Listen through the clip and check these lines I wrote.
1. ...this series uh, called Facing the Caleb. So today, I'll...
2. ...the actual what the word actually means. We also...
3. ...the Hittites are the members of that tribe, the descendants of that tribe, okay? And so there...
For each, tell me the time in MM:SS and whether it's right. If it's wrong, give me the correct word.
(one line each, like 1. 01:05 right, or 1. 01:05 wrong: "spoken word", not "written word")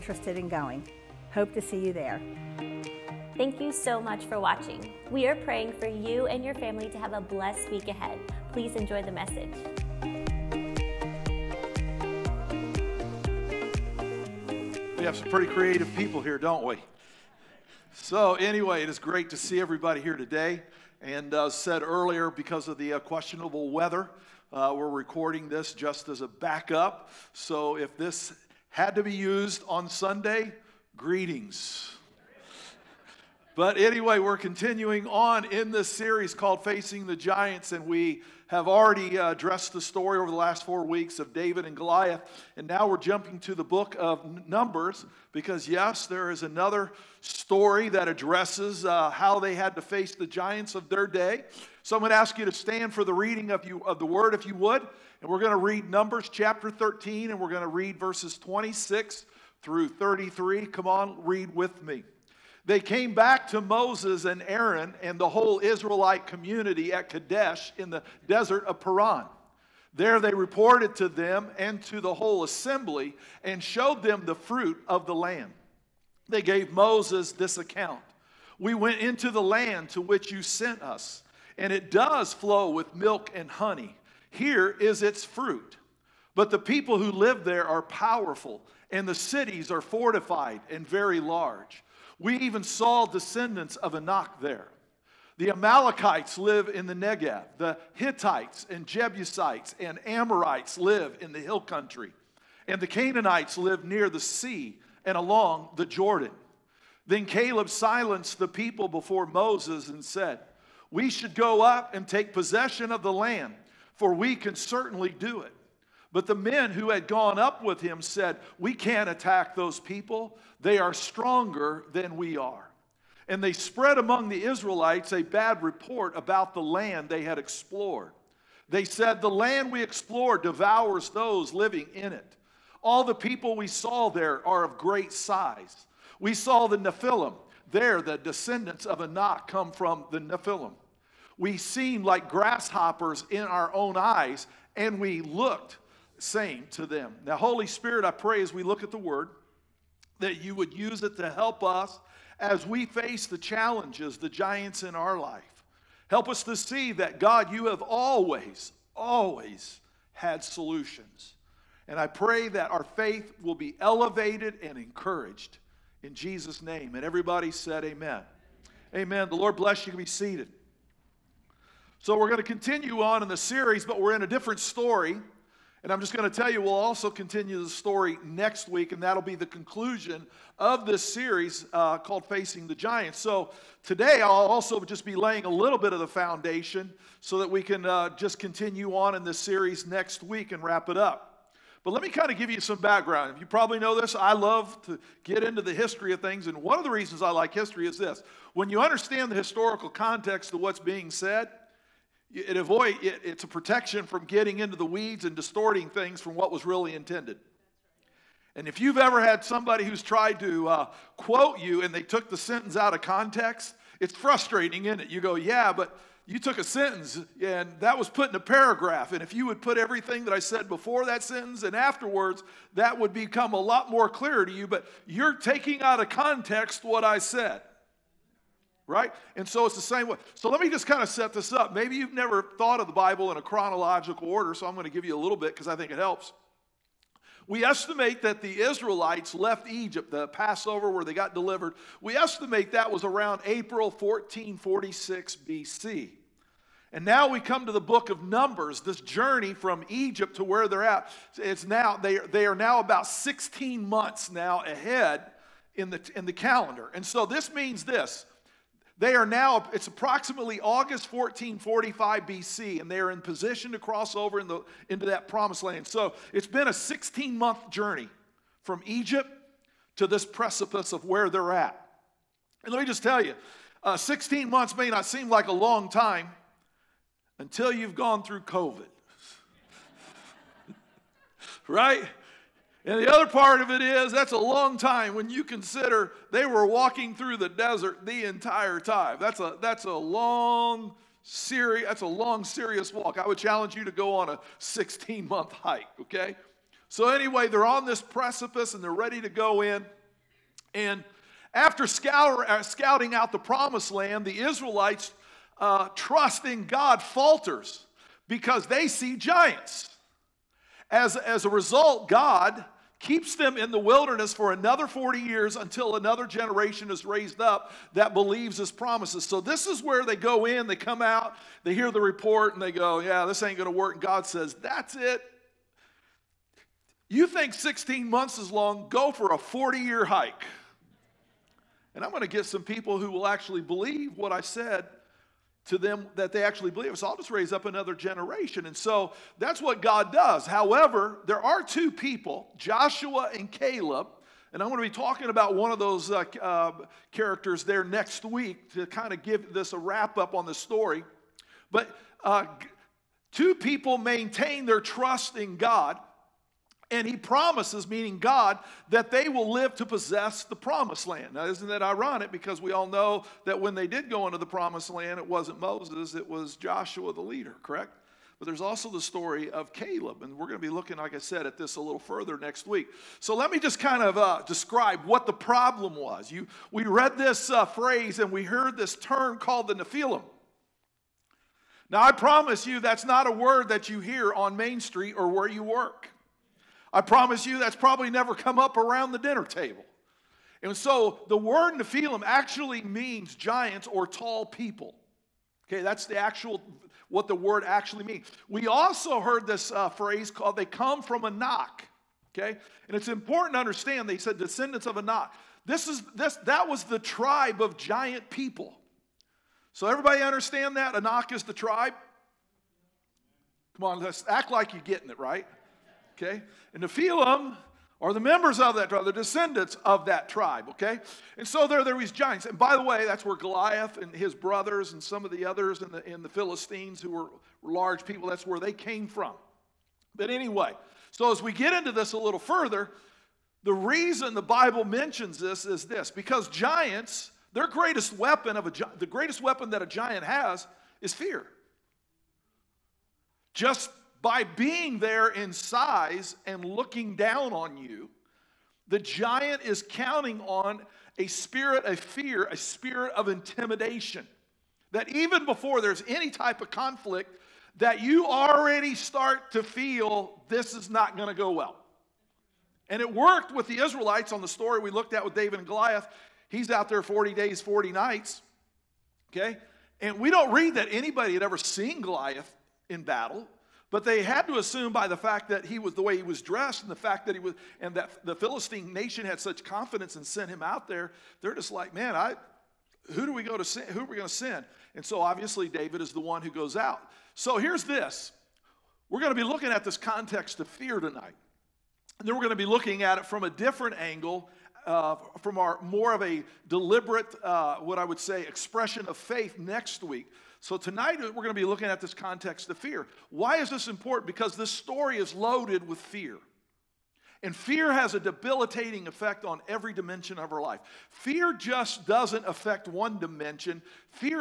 1. 03:00 wrong: "Giants", not "Caleb"
2. 06:36 right
3. 06:56 wrong: "Nephilim", not "Hittites".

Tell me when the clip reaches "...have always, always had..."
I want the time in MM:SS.
02:37.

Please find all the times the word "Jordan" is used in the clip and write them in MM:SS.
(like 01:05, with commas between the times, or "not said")
01:45.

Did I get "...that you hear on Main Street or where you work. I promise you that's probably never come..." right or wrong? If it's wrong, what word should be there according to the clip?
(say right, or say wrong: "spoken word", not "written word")
right.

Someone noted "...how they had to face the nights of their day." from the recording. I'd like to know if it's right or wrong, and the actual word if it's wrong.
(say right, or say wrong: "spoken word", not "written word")
wrong: "giants", not "nights".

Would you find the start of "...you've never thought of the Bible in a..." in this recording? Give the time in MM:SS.
03:51.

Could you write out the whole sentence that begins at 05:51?
But uh, two people maintain their trust in God.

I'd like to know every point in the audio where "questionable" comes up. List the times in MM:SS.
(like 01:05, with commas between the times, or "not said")
00:23.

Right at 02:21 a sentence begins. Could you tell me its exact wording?
We seemed like grasshoppers in our own eyes, and we looked saying to them.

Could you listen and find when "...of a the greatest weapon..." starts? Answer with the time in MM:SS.
07:18.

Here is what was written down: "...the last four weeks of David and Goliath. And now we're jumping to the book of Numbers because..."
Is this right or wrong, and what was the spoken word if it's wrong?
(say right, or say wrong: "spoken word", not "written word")
right.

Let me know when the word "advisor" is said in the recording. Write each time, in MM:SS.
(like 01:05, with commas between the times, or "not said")
not said.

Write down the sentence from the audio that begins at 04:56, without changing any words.
So anyway, they're on this precipice and they're ready to go in.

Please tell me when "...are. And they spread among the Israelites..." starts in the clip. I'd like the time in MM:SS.
02:02.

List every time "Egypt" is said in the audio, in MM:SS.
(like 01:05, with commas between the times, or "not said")
03:59, 04:09, 04:28.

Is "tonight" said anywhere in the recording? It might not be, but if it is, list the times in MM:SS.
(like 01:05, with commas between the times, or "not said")
08:10, 08:20.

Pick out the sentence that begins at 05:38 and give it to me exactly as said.
And so that's what God does.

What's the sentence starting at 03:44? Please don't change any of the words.
But you're taking out of context what I said right?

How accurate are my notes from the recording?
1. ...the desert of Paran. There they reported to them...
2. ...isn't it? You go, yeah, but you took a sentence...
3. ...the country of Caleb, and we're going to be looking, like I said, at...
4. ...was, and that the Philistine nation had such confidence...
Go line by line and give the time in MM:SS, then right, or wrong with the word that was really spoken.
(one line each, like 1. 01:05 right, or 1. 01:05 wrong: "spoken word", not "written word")
1. 01:07 right
2. 03:34 right
3. 06:08 wrong: "story", not "country"
4. 07:57 right.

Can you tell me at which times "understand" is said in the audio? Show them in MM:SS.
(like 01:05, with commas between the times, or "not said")
03:18, 06:43, 06:50.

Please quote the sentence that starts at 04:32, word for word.
And let me just tell you uh, 16 months may not seem like a long time until you've gone through COVID.